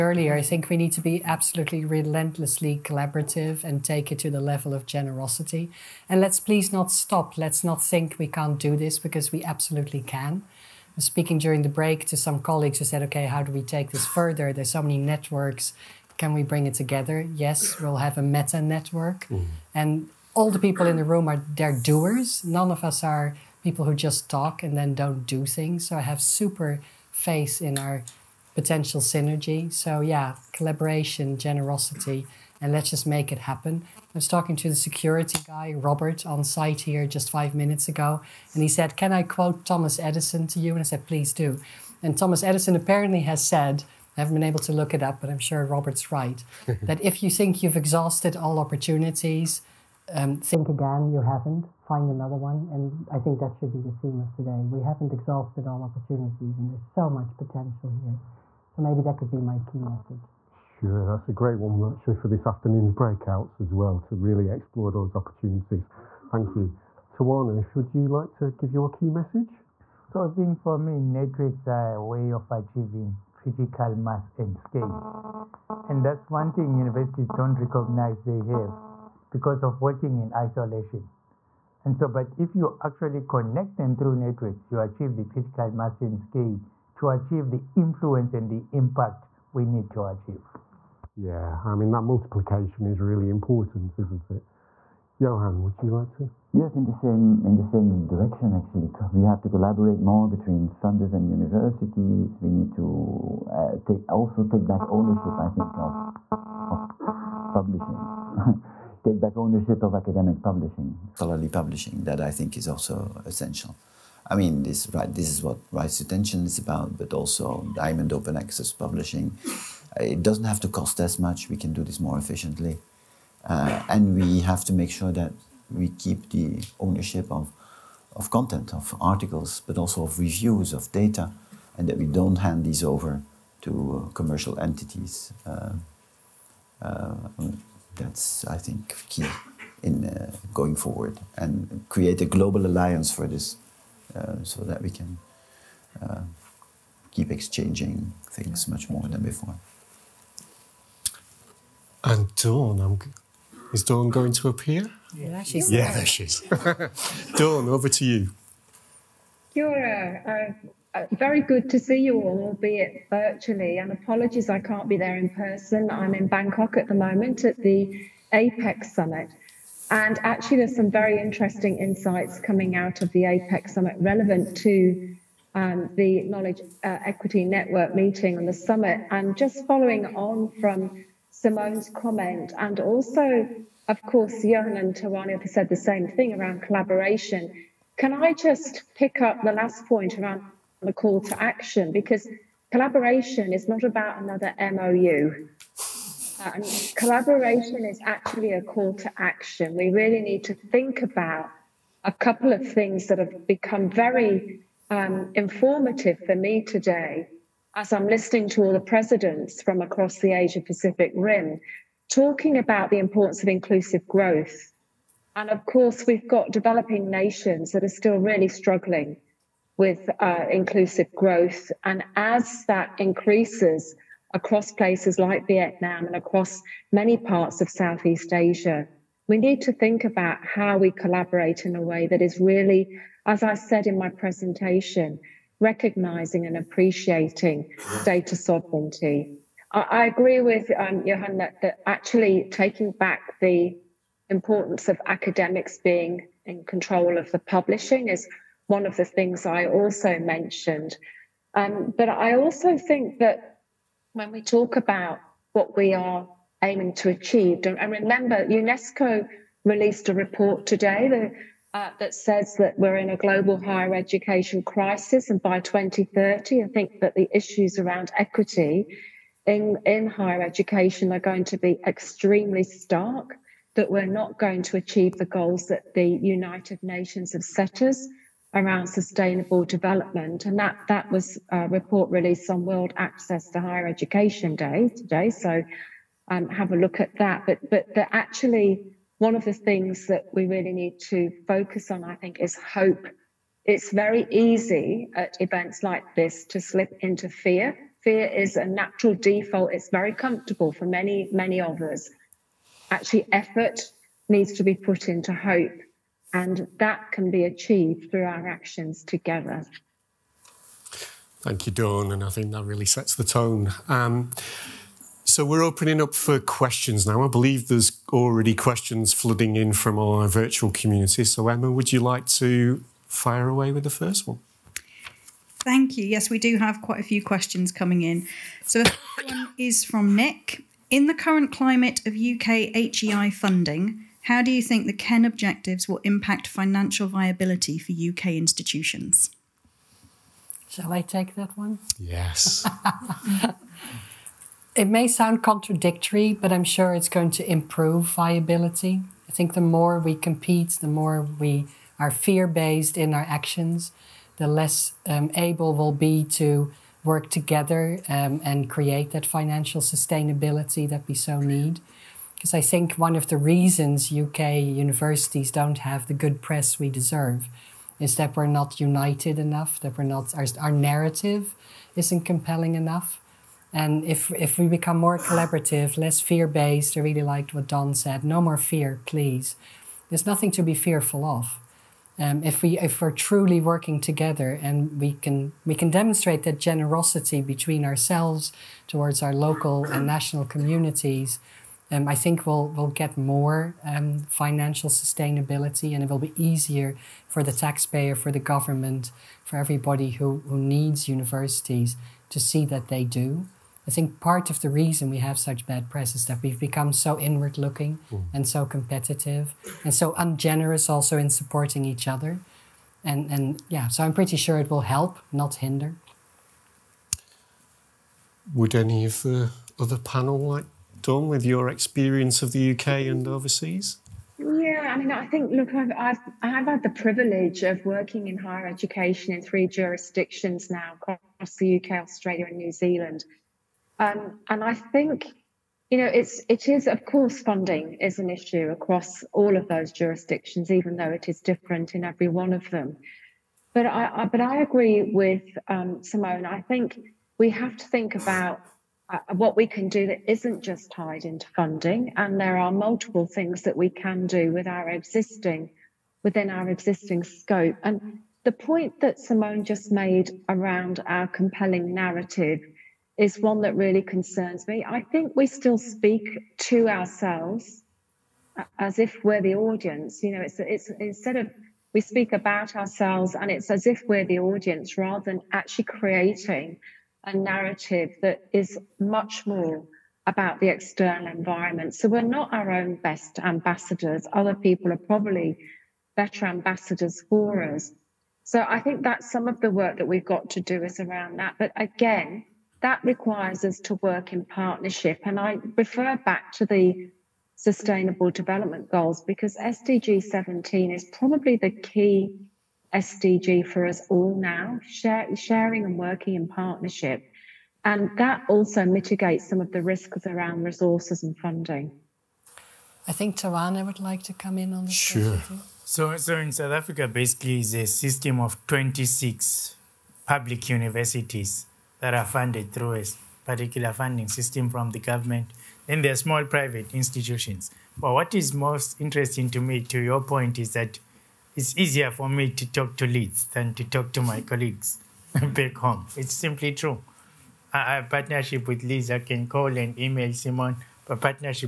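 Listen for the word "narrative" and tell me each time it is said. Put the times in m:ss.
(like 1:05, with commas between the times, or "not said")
6:10, 7:41, 7:57.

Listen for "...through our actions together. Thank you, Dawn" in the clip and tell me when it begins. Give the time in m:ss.
5:08.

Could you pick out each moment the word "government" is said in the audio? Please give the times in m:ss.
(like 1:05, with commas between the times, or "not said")
6:38, 8:44.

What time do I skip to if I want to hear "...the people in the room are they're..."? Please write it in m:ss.
0:20.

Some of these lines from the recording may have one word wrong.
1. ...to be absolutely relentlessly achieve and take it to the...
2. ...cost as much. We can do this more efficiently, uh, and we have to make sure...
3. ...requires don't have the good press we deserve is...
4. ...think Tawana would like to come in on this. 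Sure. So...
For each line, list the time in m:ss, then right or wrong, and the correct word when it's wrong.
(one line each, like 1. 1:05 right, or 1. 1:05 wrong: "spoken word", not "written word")
1. 0:00 wrong: "collaborative", not "achieve"
2. 2:00 right
3. 6:04 wrong: "universities", not "requires"
4. 8:33 right.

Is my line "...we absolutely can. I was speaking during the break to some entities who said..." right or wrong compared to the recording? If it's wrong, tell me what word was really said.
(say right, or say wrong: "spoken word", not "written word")
wrong: "colleagues", not "entities".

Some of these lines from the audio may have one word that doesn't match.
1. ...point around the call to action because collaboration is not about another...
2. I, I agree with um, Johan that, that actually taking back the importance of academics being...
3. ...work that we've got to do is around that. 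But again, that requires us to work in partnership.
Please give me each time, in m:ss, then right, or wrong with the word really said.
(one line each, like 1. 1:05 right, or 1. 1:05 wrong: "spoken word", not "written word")
1. 3:09 right
2. 3:59 right
3. 8:09 right.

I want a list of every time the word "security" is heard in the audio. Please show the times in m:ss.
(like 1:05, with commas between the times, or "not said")
0:34.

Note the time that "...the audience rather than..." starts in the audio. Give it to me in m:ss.
7:54.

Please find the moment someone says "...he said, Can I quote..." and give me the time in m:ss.
0:38.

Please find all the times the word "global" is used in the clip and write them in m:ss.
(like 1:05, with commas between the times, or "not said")
2:22, 4:23.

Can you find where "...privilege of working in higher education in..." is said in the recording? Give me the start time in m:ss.
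7:06.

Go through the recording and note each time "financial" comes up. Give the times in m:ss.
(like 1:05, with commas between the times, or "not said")
5:36, 5:59, 6:34.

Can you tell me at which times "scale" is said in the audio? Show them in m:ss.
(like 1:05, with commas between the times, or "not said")
1:14, 1:26.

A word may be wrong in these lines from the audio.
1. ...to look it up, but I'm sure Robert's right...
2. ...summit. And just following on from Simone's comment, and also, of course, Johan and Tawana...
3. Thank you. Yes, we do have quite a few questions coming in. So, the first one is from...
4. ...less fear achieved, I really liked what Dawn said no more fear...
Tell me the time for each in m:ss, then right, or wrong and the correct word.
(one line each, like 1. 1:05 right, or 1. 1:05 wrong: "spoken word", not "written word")
1. 0:44 right
2. 2:58 right
3. 5:25 right
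4. 6:15 wrong: "based", not "achieved".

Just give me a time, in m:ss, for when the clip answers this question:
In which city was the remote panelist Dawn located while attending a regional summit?
2:46.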